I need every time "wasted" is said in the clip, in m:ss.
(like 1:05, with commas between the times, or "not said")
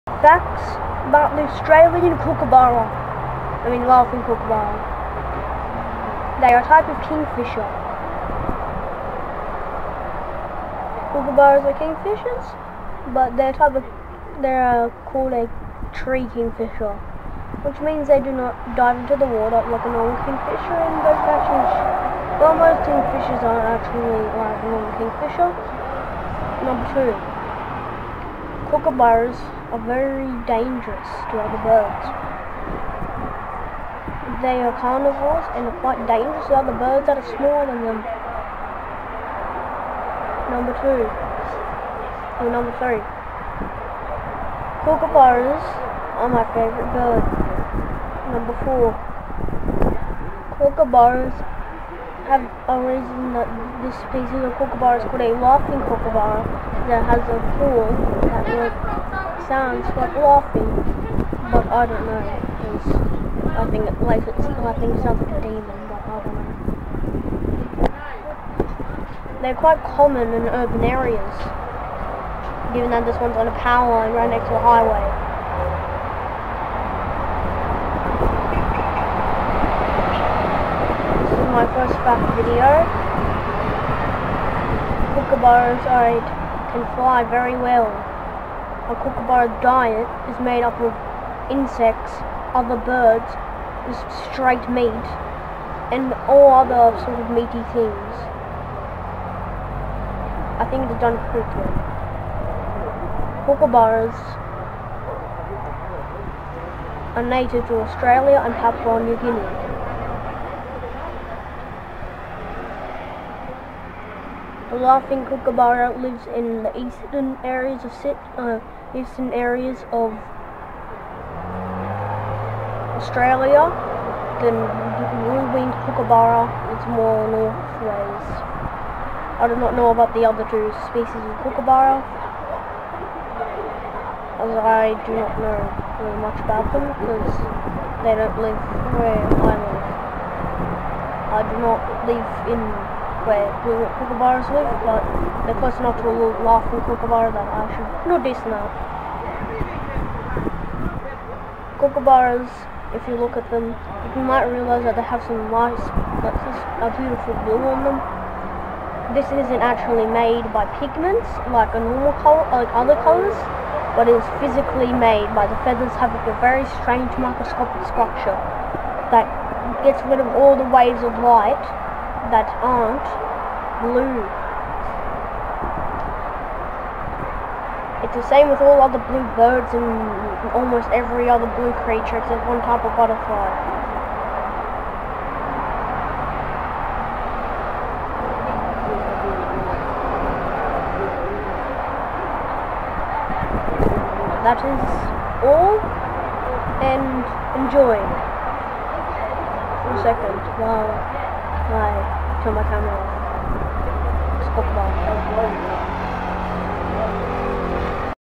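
not said.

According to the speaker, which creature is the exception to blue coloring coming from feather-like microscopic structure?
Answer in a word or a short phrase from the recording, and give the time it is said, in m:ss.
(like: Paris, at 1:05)
Butterfly, at 3:02.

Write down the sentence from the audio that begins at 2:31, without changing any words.
Kookaburras, if you look at them, you might realize that they have some lights, like a beautiful blue on them.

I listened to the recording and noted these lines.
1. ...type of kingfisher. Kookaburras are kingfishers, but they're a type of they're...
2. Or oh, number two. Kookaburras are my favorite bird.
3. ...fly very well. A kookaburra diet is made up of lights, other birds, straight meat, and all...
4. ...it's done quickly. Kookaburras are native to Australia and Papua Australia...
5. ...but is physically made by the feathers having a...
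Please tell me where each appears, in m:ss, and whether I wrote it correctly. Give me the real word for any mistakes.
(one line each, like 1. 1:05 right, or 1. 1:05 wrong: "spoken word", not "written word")
1. 0:06 right
2. 0:41 wrong: "three", not "two"
3. 1:26 wrong: "insects", not "lights"
4. 1:40 wrong: "New", not "Australia"
5. 2:43 right.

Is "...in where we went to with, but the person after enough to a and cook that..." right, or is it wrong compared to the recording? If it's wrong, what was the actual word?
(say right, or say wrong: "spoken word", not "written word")
right.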